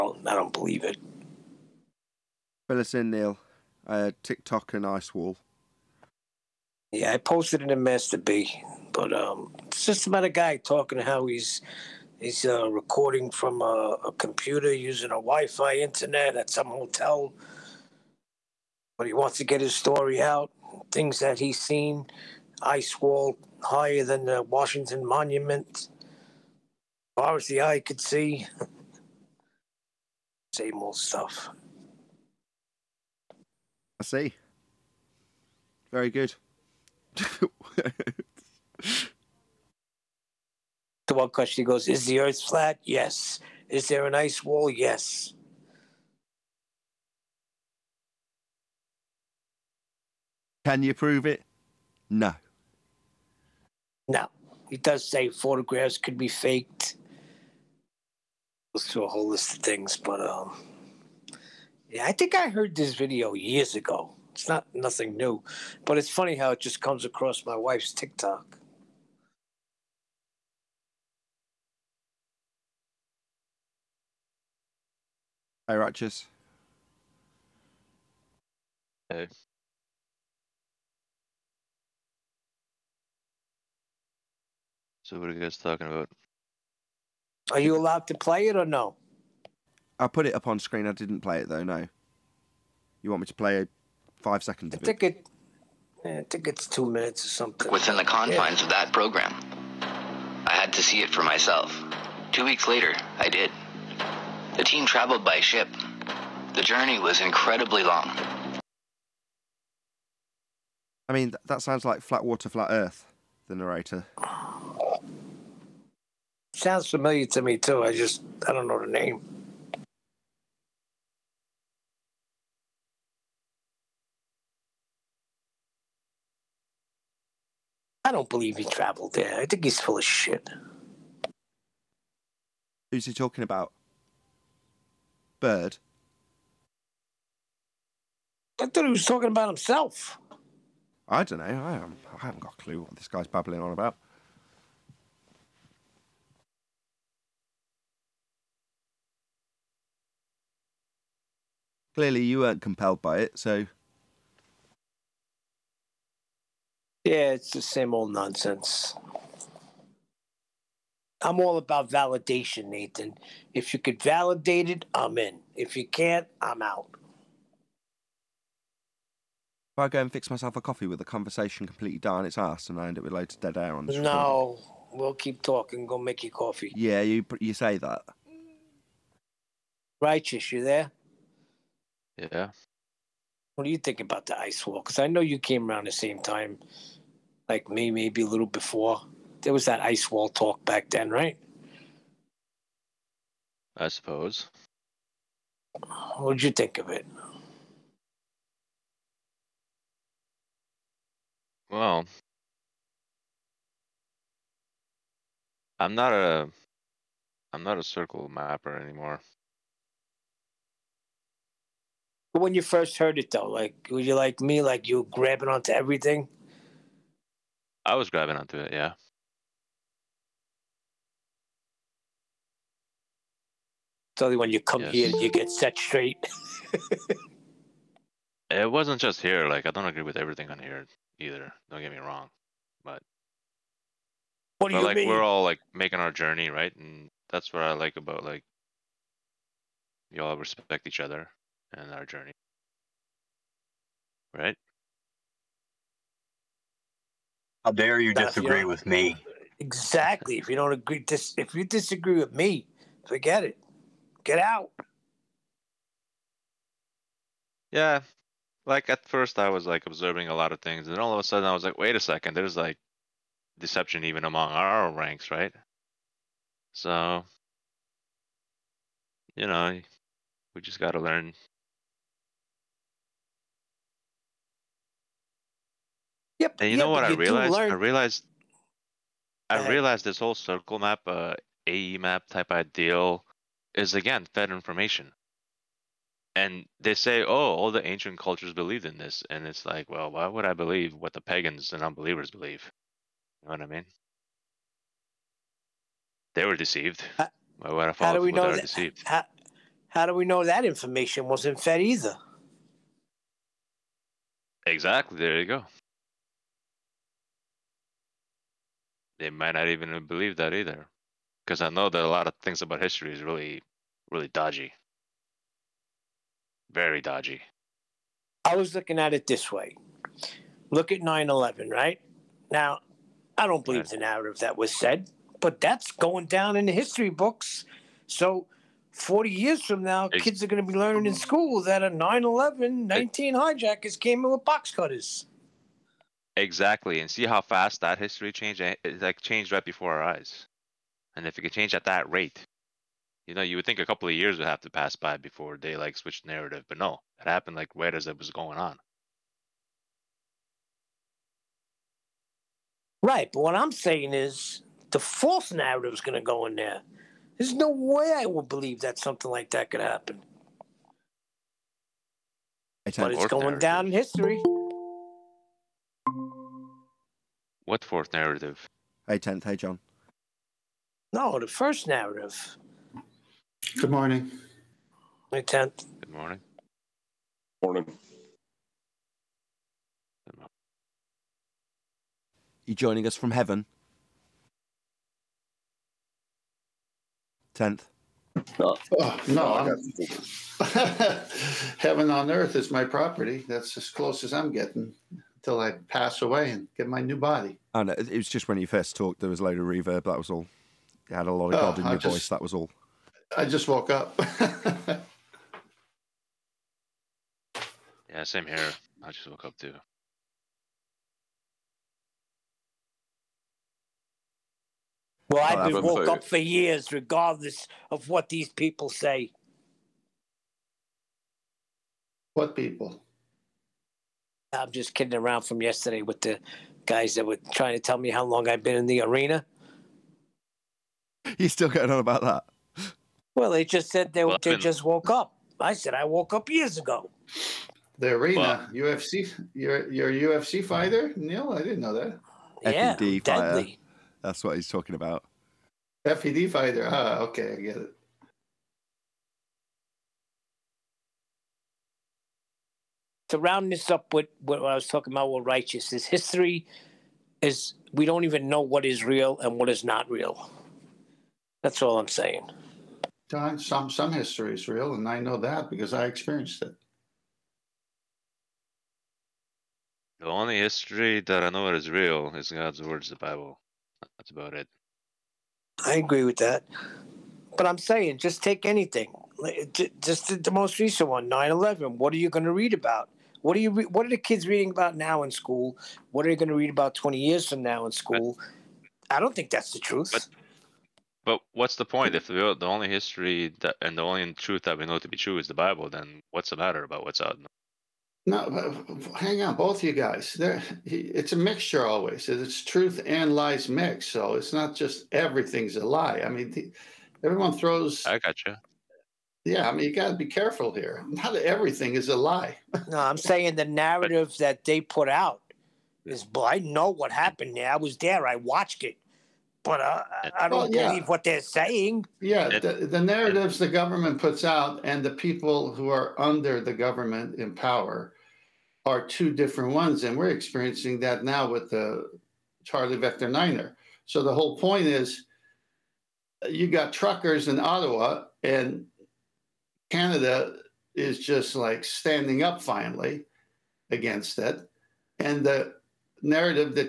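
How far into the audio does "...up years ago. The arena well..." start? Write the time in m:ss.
7:16.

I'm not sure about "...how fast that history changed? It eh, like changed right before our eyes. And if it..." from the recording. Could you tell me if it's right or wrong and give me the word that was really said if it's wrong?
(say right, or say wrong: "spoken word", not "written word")
right.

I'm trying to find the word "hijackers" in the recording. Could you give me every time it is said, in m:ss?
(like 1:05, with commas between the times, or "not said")
5:33.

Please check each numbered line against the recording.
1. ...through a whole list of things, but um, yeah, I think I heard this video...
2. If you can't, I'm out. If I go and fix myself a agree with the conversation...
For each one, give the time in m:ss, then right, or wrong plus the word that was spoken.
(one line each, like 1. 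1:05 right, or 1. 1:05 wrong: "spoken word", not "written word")
1. 0:58 right
2. 2:45 wrong: "coffee", not "agree".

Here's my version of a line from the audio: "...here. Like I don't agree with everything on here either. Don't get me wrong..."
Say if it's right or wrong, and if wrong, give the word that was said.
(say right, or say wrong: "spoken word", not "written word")
right.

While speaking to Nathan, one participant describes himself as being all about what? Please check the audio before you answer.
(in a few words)
Validation.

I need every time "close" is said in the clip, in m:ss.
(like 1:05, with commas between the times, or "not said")
6:33.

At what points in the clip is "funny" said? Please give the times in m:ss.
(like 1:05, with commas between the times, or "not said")
1:06.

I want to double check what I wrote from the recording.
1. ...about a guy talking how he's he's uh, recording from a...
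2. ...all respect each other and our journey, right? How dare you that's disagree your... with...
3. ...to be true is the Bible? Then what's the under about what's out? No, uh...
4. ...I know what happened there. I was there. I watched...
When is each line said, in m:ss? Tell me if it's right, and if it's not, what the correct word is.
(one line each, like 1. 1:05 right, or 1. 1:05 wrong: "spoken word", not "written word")
1. 0:10 right
2. 4:00 right
3. 8:14 wrong: "matter", not "under"
4. 8:36 right.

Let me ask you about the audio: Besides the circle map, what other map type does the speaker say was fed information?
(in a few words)
AE map.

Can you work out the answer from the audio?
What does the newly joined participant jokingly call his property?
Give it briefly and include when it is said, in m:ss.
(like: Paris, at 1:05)
Heaven on earth, at 6:31.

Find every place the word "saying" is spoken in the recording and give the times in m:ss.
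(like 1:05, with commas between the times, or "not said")
5:53, 7:42, 7:57, 8:33, 8:41.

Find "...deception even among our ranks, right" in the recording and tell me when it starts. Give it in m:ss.
4:23.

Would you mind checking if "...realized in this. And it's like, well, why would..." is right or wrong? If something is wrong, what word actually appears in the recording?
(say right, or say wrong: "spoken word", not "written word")
wrong: "believed", not "realized".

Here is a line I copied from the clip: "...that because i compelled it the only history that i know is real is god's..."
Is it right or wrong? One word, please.
wrong.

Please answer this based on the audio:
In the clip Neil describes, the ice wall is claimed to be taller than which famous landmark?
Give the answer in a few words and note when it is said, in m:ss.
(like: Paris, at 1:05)
Washington Monument, at 0:24.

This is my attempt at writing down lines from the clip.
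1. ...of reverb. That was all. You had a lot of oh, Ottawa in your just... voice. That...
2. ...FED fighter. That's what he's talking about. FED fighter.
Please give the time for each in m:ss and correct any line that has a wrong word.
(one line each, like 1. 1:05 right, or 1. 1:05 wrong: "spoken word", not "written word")
1. 6:39 wrong: "God", not "Ottawa"
2. 7:22 right.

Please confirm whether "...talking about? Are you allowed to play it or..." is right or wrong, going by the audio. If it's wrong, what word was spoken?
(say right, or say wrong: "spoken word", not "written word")
right.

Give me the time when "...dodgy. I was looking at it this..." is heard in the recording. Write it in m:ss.
5:17.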